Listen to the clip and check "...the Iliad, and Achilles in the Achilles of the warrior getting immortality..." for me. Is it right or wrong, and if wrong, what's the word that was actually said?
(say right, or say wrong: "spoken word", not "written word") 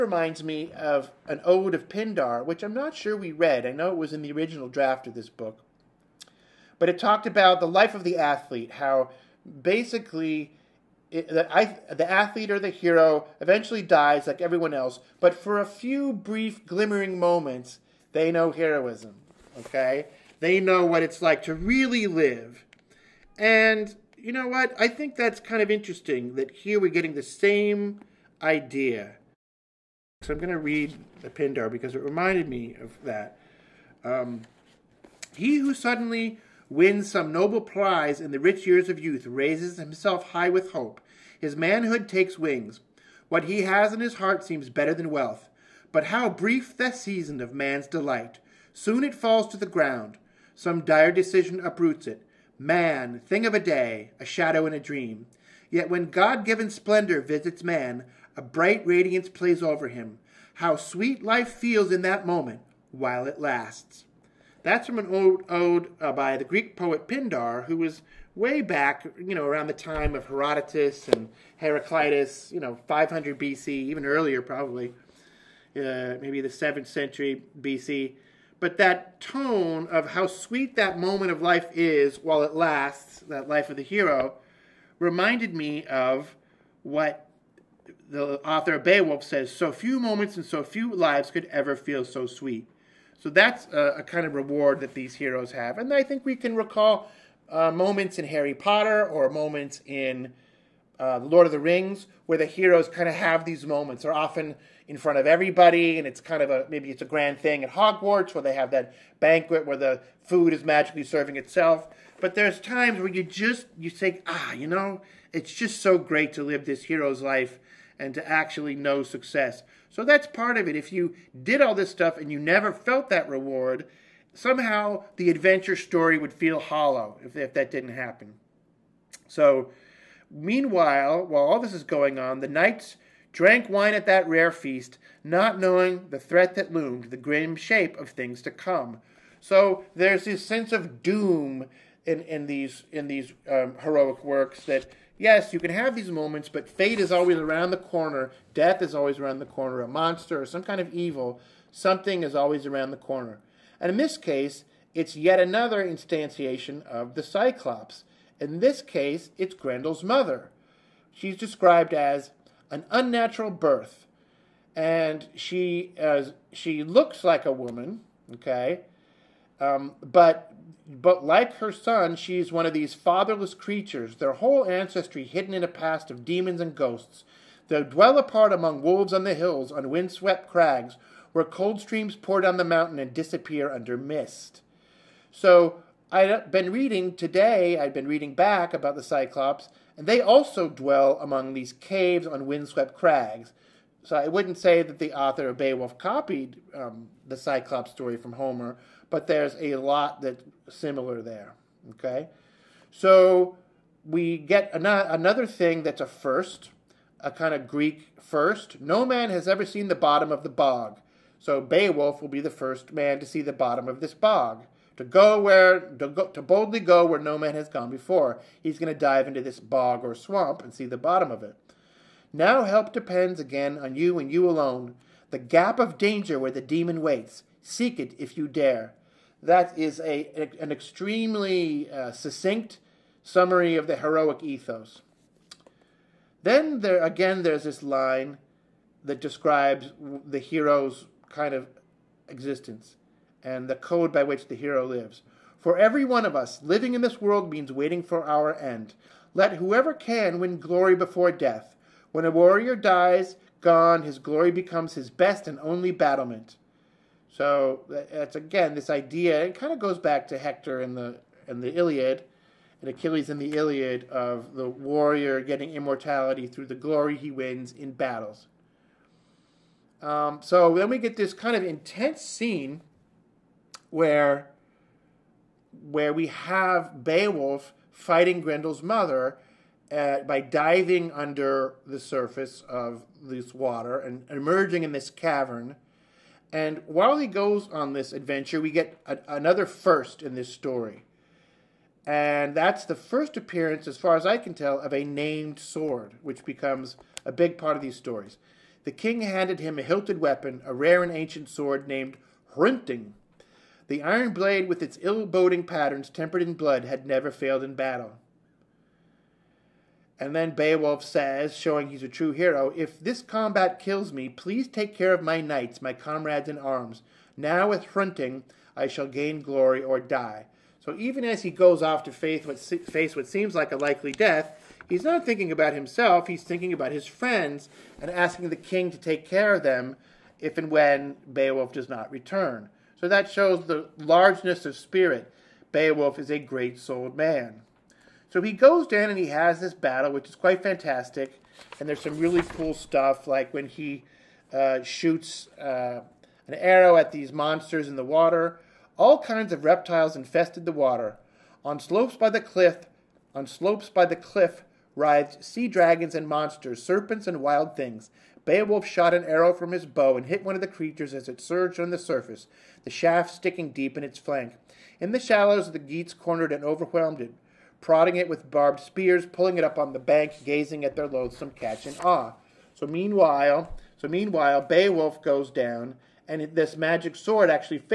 wrong: "Iliad", not "Achilles".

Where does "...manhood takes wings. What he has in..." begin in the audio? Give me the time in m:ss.
0:41.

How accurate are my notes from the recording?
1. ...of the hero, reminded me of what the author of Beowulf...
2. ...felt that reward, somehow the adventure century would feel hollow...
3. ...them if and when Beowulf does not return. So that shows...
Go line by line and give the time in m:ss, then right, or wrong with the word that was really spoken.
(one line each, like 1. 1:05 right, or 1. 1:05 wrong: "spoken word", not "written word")
1. 1:23 right
2. 2:02 wrong: "story", not "century"
3. 5:29 right.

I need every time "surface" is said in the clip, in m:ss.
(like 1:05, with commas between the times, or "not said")
4:41, 6:01.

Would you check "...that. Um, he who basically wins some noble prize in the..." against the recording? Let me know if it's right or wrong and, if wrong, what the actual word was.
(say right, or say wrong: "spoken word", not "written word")
wrong: "suddenly", not "basically".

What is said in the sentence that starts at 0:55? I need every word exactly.
Yet when God-given splendor visits man, a bright radiance plays over him.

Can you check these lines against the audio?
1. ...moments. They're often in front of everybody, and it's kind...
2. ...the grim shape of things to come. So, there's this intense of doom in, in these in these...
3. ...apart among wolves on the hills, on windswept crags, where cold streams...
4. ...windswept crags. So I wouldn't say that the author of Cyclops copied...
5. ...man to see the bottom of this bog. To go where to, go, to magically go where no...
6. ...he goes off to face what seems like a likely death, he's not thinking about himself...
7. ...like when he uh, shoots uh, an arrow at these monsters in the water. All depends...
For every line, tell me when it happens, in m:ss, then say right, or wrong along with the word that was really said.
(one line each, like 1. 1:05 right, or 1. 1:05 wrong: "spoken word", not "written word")
1. 1:43 right
2. 2:17 wrong: "sense", not "intense"
3. 2:58 right
4. 3:12 wrong: "Beowulf", not "Cyclops"
5. 3:32 wrong: "boldly", not "magically"
6. 5:21 right
7. 5:43 wrong: "kinds", not "depends".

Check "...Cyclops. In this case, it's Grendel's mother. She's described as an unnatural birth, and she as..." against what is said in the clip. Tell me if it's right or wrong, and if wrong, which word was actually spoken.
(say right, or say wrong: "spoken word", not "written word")
right.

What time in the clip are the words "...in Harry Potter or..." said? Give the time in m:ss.
1:38.